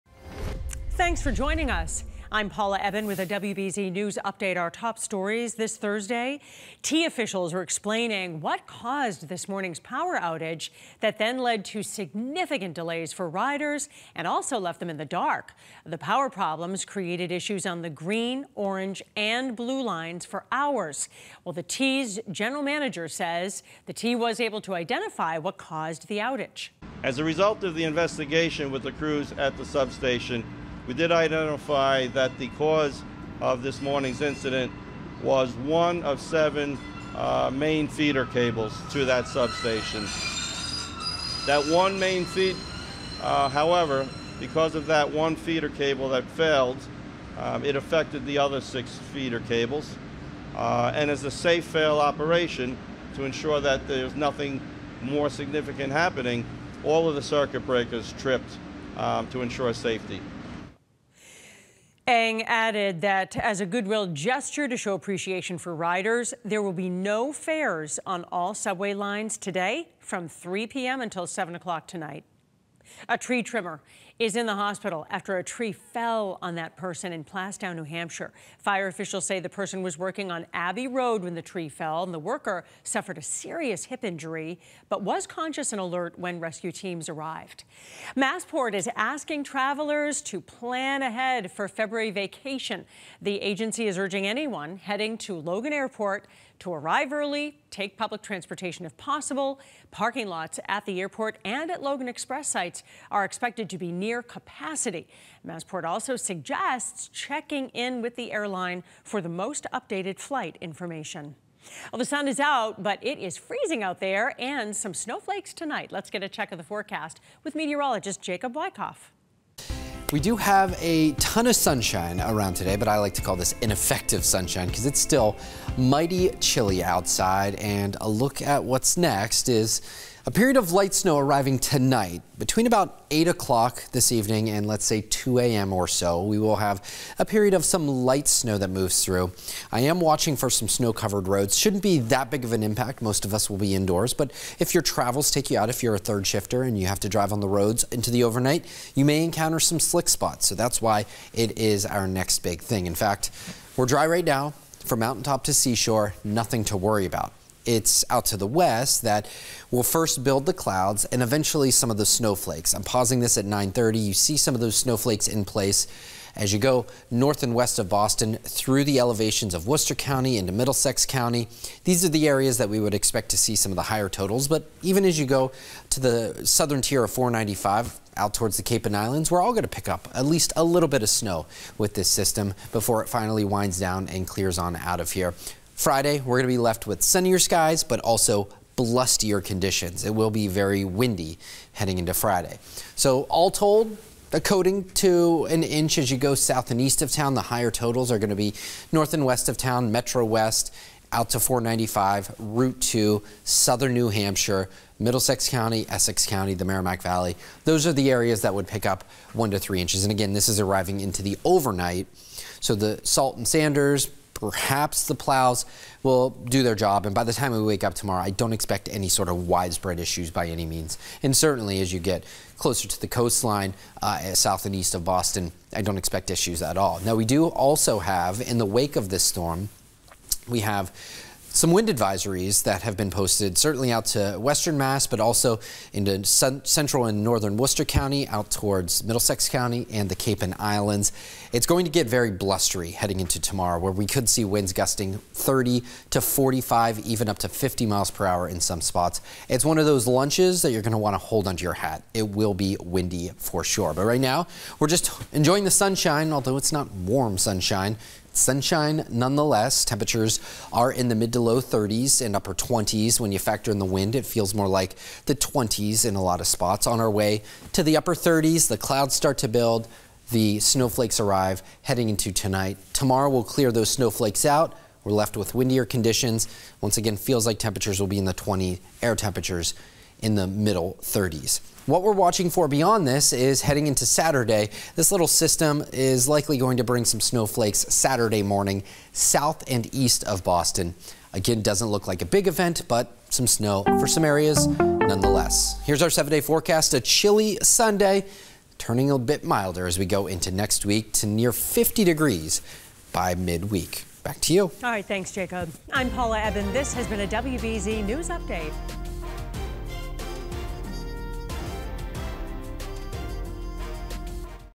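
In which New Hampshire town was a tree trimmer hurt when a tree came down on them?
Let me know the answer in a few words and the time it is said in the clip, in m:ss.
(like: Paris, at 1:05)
Plaistow, at 1:17.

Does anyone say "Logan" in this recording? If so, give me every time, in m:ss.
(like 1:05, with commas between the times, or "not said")
1:35, 1:41.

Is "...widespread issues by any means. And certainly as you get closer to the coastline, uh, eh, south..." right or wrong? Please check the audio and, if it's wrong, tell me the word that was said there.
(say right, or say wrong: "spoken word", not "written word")
right.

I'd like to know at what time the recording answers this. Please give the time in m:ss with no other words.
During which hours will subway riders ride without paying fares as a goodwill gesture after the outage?
1:10.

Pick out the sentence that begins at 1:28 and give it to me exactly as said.
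Massport is asking travelers to plan ahead for February vacation.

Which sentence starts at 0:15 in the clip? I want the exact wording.
The power problems created issues on the green, orange, and blue lines for hours.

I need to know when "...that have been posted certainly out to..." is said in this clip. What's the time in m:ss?
3:52.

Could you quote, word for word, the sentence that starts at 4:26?
On our way to the upper 30s, the clouds start to build, the snowflakes arrive heading into tonight.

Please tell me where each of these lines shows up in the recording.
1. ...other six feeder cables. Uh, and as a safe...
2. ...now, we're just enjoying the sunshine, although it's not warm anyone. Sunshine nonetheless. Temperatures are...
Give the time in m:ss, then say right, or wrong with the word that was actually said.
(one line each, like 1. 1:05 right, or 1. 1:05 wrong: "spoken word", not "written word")
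1. 0:48 right
2. 4:14 wrong: "sunshine", not "anyone".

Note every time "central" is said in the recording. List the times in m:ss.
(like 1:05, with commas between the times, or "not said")
3:56.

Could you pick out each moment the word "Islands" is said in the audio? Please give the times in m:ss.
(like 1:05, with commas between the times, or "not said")
2:58, 4:00.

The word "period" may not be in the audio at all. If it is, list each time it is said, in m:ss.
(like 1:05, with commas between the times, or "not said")
2:10, 2:17.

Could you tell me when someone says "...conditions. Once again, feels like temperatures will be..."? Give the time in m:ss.
4:35.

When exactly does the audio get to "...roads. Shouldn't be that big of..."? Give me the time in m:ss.
2:21.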